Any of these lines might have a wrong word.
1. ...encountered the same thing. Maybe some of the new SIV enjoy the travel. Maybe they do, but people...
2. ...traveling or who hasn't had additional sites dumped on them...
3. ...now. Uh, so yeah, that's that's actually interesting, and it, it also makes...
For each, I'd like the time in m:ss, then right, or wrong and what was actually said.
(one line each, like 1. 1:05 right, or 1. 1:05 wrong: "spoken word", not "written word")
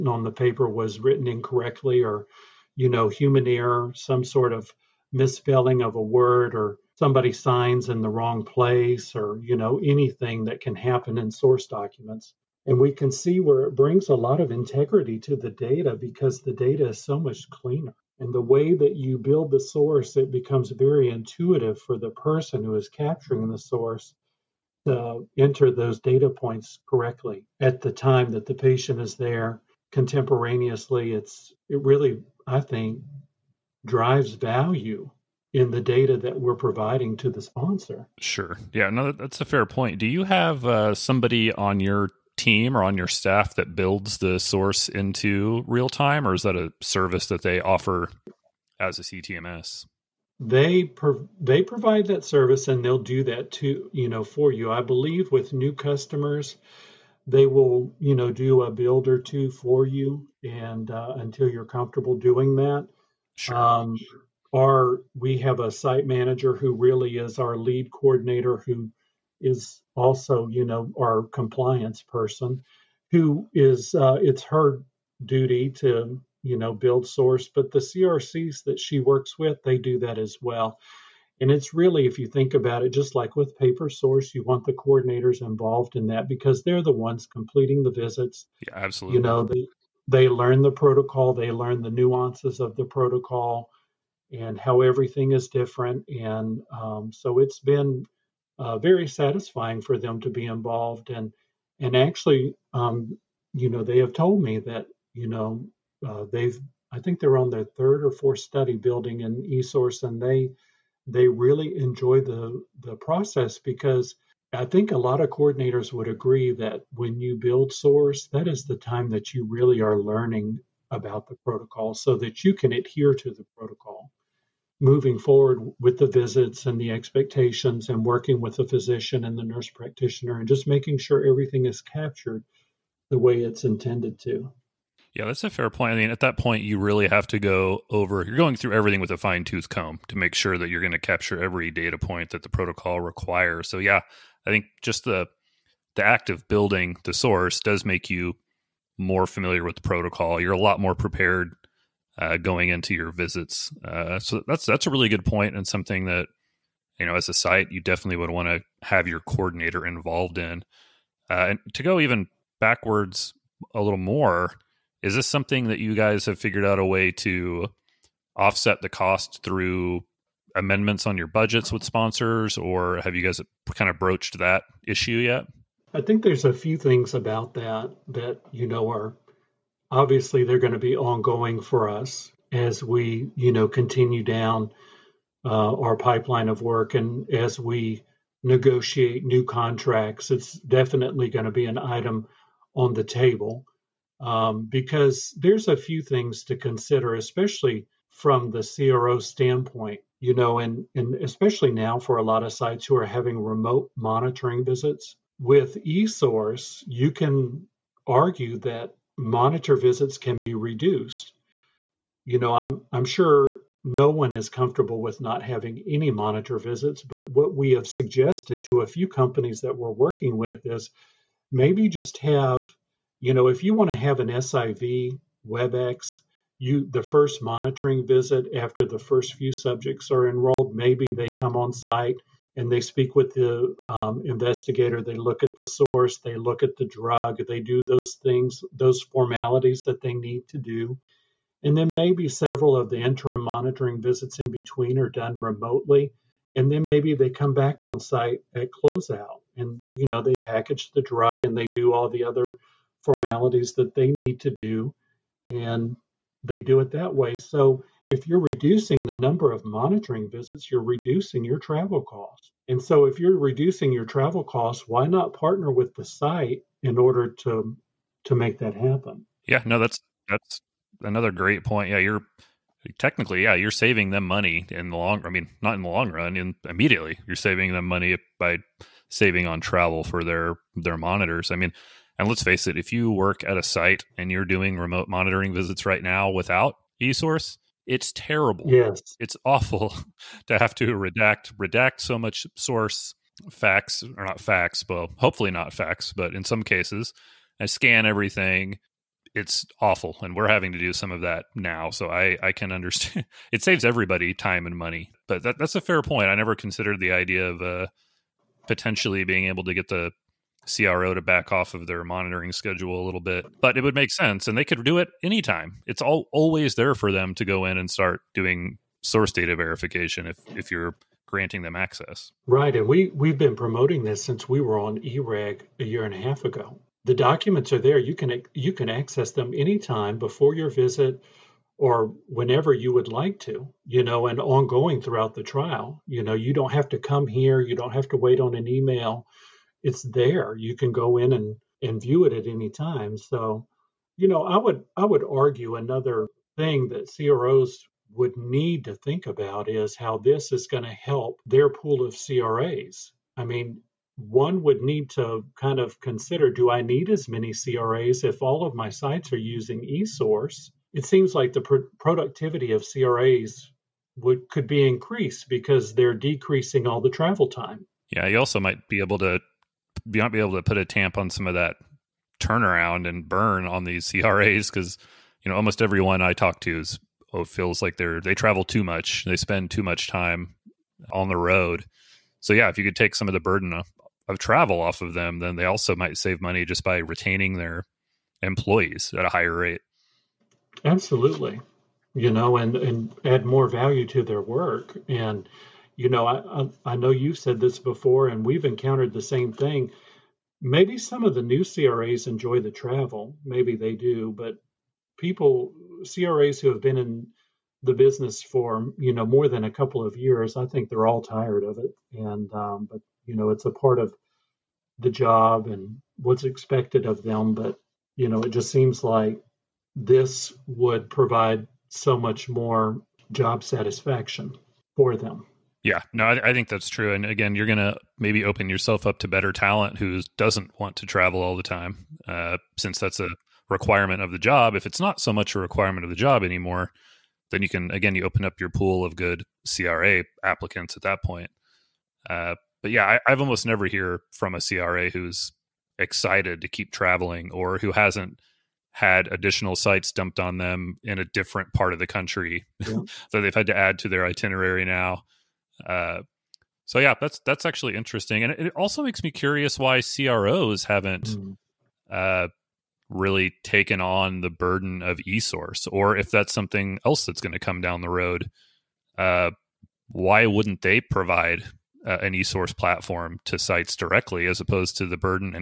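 1. 6:38 wrong: "CRAs", not "SIV"
2. 7:26 right
3. 7:34 right.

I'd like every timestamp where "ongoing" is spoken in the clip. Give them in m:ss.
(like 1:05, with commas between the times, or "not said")
3:00, 5:34.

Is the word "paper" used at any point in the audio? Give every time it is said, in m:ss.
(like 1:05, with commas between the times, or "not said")
0:00, 1:23.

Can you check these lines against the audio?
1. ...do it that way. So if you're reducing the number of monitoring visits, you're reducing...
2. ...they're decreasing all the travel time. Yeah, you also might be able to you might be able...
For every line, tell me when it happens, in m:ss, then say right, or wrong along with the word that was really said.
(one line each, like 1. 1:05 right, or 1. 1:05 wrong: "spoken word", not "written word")
1. 4:16 right
2. 6:05 right.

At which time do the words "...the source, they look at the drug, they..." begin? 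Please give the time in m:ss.
3:55.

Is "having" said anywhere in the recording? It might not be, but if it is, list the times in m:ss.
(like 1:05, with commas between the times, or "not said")
3:23, 3:35, 5:00.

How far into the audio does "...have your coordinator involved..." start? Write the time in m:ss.
2:38.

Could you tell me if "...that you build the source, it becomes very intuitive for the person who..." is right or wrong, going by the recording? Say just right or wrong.
right.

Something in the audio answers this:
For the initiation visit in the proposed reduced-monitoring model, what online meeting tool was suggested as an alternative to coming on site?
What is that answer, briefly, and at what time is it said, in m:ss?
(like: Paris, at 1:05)
WebEx, at 3:45.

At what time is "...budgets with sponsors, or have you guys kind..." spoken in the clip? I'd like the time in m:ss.
2:51.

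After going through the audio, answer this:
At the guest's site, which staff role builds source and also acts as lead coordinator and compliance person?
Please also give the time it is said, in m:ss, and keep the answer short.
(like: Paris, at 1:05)
site manager, at 1:05.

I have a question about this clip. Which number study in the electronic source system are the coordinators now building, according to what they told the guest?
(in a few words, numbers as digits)
third or fourth.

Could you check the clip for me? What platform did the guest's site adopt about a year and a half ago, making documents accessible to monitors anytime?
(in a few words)
EREG.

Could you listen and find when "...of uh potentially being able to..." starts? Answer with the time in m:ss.
5:07.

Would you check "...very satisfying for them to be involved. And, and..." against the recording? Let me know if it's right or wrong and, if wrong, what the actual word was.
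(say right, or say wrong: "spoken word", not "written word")
right.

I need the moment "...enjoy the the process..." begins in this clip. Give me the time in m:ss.
1:51.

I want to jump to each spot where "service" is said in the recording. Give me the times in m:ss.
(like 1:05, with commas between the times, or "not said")
0:46, 0:52.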